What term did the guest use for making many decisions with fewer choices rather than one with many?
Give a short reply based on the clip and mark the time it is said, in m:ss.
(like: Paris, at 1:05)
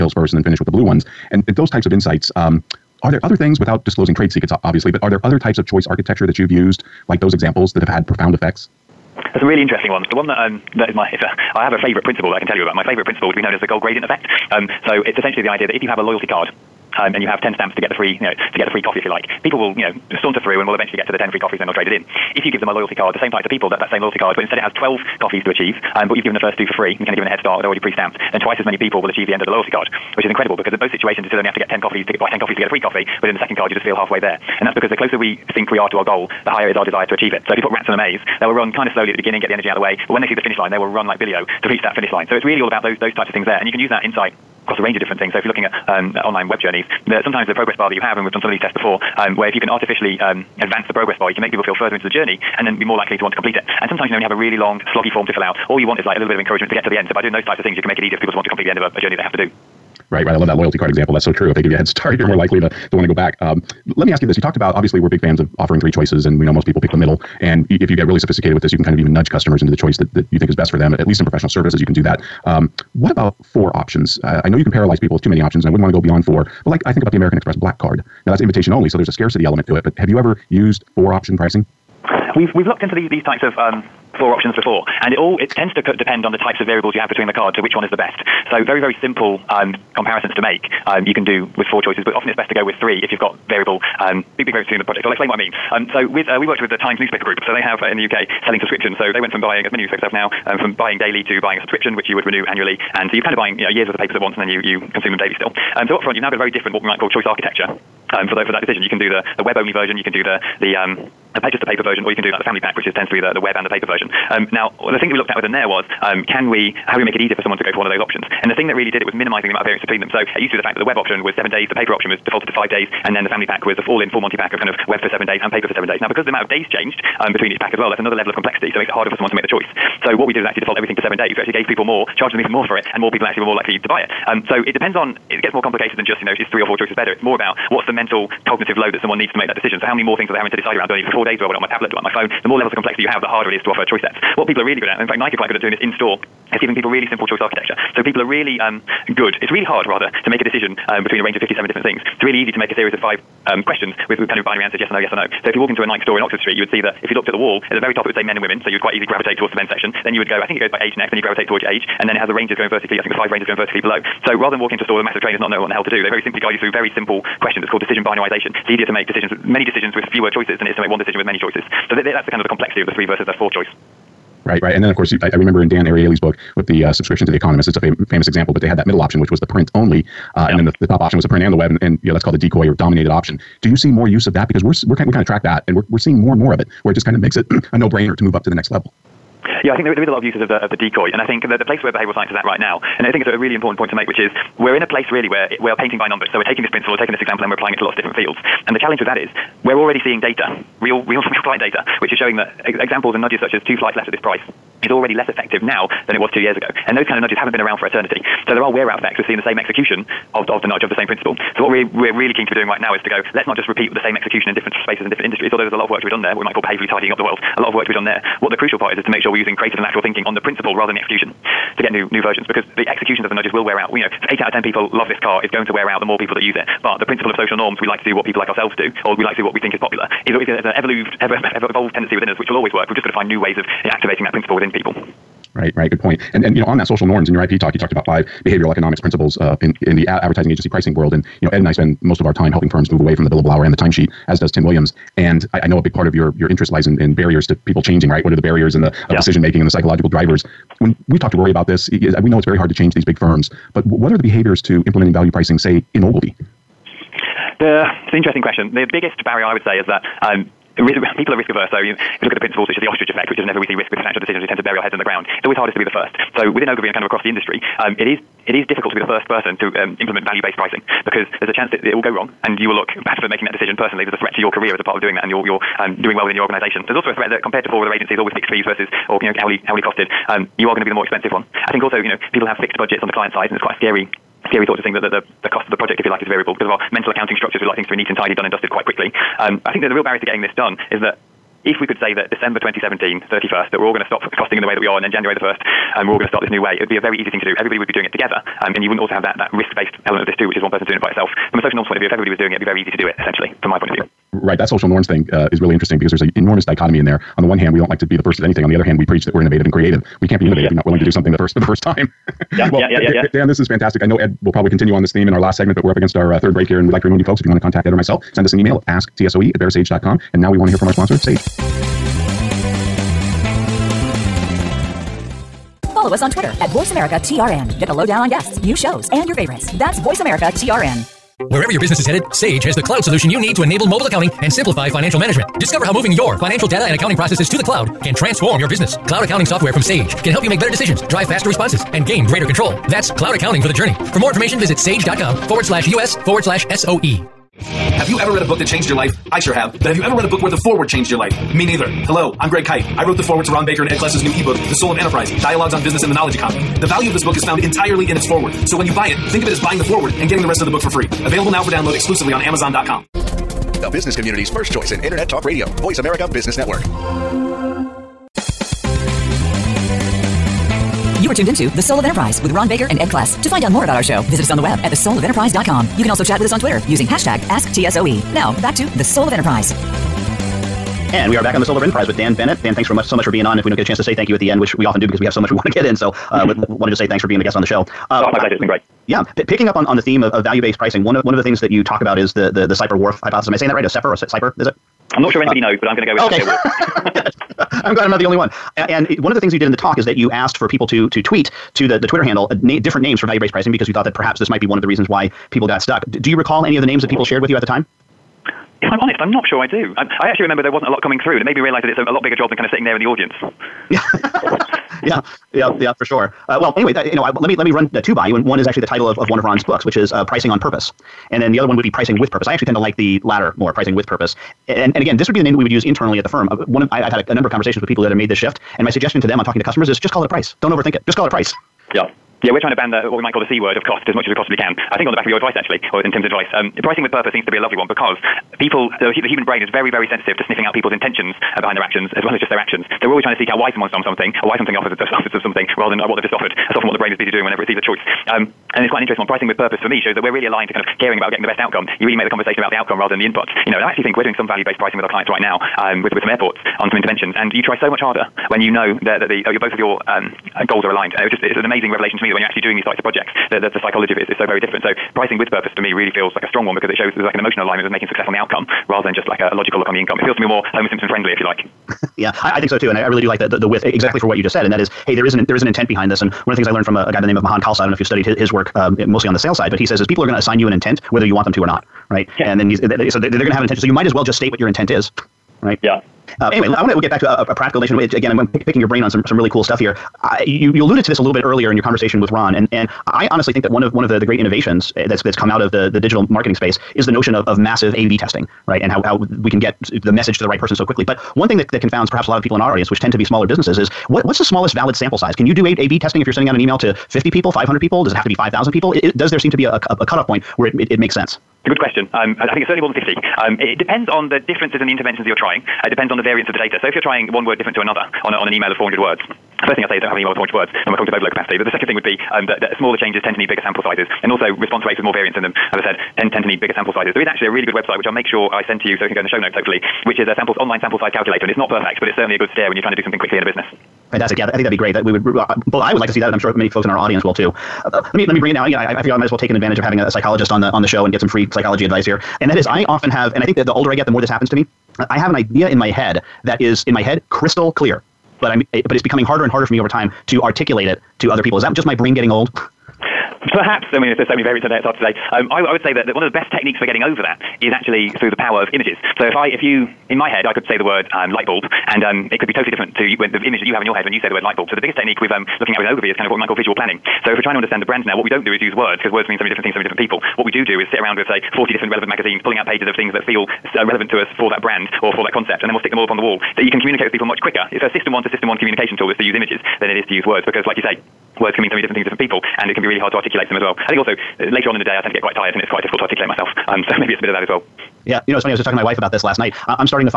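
decision binarization, at 2:47.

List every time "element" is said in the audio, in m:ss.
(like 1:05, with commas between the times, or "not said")
1:19, 5:00.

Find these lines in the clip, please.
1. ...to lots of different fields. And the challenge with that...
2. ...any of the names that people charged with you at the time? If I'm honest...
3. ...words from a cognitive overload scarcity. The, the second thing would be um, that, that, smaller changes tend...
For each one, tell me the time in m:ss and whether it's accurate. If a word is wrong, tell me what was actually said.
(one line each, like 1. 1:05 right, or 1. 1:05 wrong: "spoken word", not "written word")
1. 3:17 right
2. 6:46 wrong: "shared", not "charged"
3. 8:40 wrong: "capacity", not "scarcity".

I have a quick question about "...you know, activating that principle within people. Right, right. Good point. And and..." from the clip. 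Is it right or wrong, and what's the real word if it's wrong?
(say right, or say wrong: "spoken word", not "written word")
right.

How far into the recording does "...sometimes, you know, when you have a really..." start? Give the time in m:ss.
0:53.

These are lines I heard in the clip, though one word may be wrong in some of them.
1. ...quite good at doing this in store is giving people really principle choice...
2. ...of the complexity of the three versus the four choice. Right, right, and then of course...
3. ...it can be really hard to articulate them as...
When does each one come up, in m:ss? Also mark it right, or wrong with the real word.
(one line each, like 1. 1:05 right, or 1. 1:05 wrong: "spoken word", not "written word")
1. 2:25 wrong: "simple", not "principle"
2. 2:52 right
3. 9:42 right.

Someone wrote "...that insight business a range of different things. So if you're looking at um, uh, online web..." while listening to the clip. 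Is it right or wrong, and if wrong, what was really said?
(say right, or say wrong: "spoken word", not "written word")
wrong: "across", not "business".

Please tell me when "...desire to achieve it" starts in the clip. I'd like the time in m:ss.
0:36.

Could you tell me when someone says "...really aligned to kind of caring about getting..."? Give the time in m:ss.
7:30.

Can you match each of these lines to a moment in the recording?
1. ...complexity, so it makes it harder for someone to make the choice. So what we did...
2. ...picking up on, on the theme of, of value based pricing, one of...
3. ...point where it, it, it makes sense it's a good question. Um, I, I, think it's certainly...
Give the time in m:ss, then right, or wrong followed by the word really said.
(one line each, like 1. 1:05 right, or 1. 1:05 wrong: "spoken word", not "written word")
1. 2:08 right
2. 6:29 right
3. 8:30 right.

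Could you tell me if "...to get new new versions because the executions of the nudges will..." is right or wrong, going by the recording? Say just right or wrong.
right.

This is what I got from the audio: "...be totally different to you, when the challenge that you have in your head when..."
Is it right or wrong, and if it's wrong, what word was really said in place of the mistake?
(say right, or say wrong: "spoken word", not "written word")
wrong: "image", not "challenge".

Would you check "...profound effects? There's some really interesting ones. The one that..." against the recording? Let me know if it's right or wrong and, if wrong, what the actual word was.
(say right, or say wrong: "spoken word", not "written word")
right.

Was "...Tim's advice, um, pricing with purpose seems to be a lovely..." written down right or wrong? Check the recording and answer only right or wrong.
right.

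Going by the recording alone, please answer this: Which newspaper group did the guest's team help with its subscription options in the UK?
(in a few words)
The Times.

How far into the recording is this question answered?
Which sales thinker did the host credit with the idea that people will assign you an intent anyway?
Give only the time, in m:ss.
7:57.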